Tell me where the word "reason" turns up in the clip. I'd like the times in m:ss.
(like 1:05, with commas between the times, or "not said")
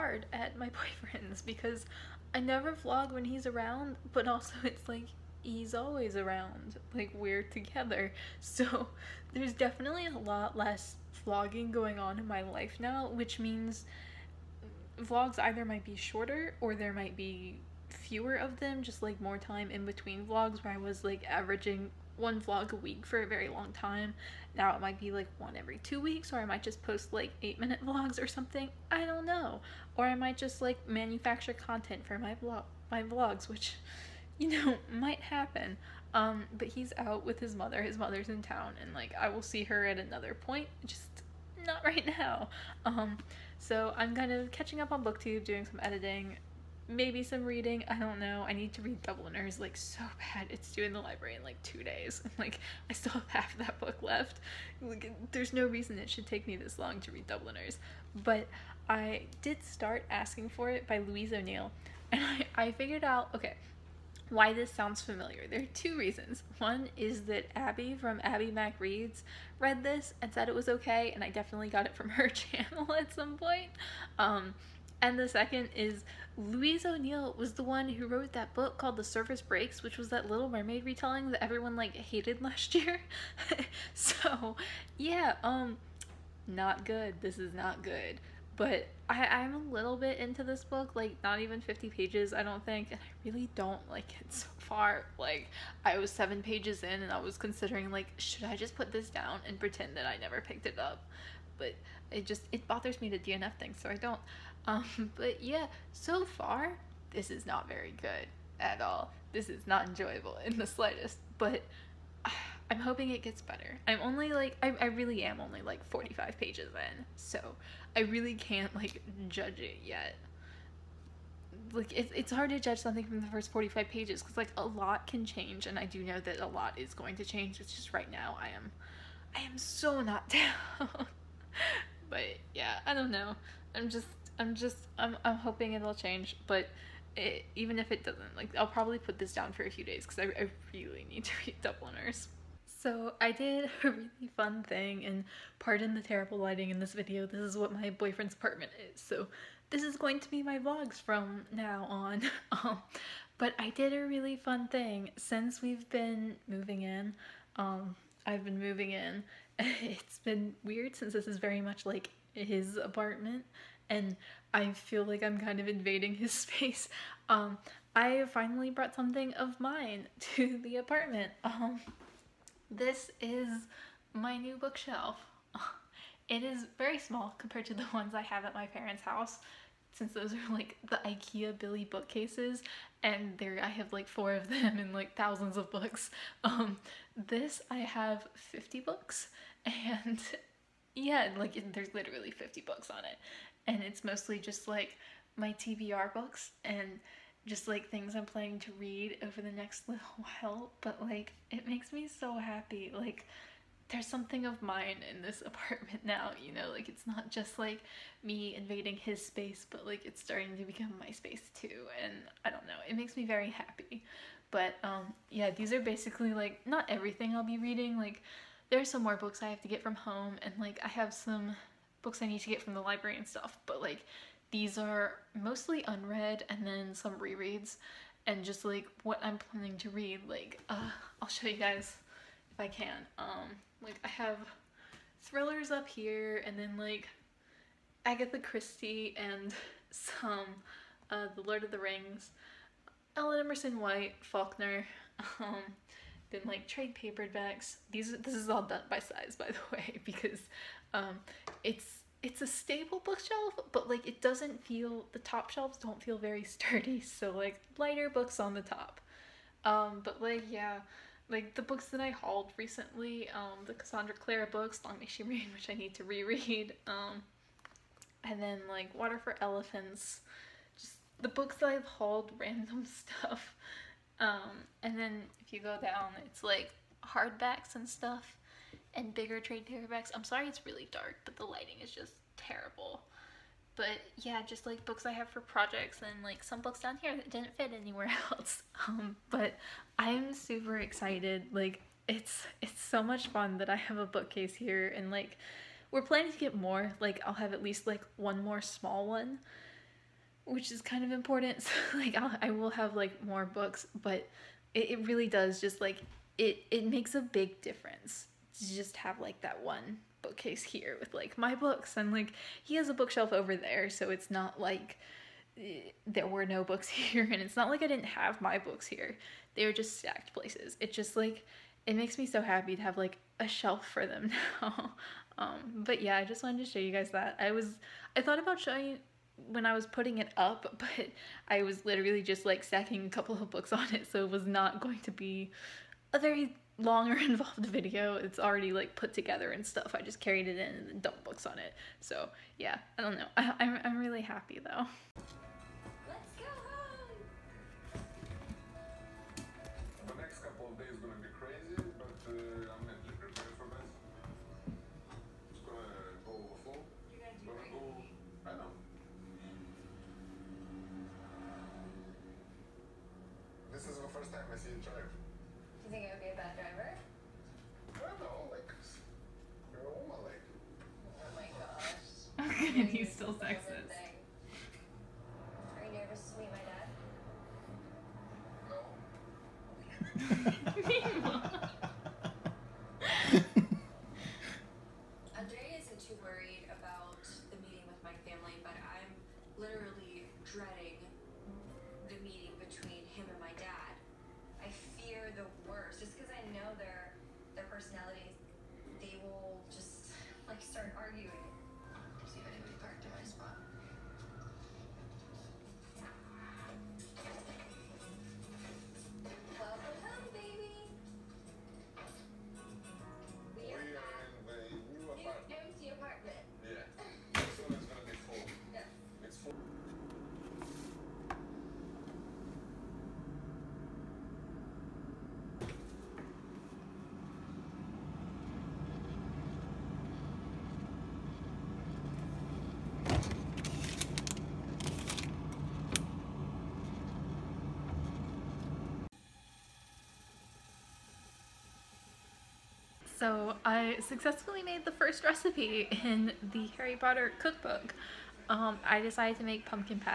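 0:55, 1:05.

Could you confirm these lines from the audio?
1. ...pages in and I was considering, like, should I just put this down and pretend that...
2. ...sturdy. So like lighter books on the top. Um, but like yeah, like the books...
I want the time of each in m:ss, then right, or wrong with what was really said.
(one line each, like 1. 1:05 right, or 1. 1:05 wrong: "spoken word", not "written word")
1. 1:36 right
2. 4:16 right.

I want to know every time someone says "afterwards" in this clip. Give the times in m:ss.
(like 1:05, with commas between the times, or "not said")
not said.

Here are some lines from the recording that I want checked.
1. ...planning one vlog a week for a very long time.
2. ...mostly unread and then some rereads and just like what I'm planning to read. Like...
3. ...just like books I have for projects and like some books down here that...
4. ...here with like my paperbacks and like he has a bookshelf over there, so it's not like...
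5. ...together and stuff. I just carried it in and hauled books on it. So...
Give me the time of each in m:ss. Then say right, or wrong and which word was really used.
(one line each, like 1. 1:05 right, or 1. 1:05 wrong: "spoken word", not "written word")
1. 0:21 wrong: "averaging", not "planning"
2. 3:45 right
3. 4:44 right
4. 5:10 wrong: "books", not "paperbacks"
5. 5:39 wrong: "dumped", not "hauled".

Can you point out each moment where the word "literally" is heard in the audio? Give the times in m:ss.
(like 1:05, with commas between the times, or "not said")
3:11, 5:31.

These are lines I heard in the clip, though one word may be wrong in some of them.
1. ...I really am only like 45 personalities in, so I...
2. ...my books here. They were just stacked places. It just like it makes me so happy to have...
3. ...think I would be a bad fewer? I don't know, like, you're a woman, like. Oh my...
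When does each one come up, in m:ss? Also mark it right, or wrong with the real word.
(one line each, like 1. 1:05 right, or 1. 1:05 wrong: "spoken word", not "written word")
1. 1:54 wrong: "pages", not "personalities"
2. 5:18 right
3. 6:05 wrong: "driver", not "fewer".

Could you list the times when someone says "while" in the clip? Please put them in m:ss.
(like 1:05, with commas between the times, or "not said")
3:20.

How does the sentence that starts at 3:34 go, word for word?
But um, yeah, these are basically like not everything I'll be reading.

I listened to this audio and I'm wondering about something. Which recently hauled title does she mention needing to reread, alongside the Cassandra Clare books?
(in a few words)
Long May She Reign.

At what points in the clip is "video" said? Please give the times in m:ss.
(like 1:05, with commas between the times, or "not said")
2:26, 5:37.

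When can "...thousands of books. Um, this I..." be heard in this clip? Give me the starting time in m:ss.
3:05.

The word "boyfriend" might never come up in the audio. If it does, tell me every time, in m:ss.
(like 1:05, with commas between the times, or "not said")
0:00, 2:27.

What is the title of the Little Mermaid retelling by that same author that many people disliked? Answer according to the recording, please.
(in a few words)
The Surface Breaks.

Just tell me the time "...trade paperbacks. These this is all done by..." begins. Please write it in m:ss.
4:06.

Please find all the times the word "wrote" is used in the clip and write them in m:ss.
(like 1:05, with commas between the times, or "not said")
1:18.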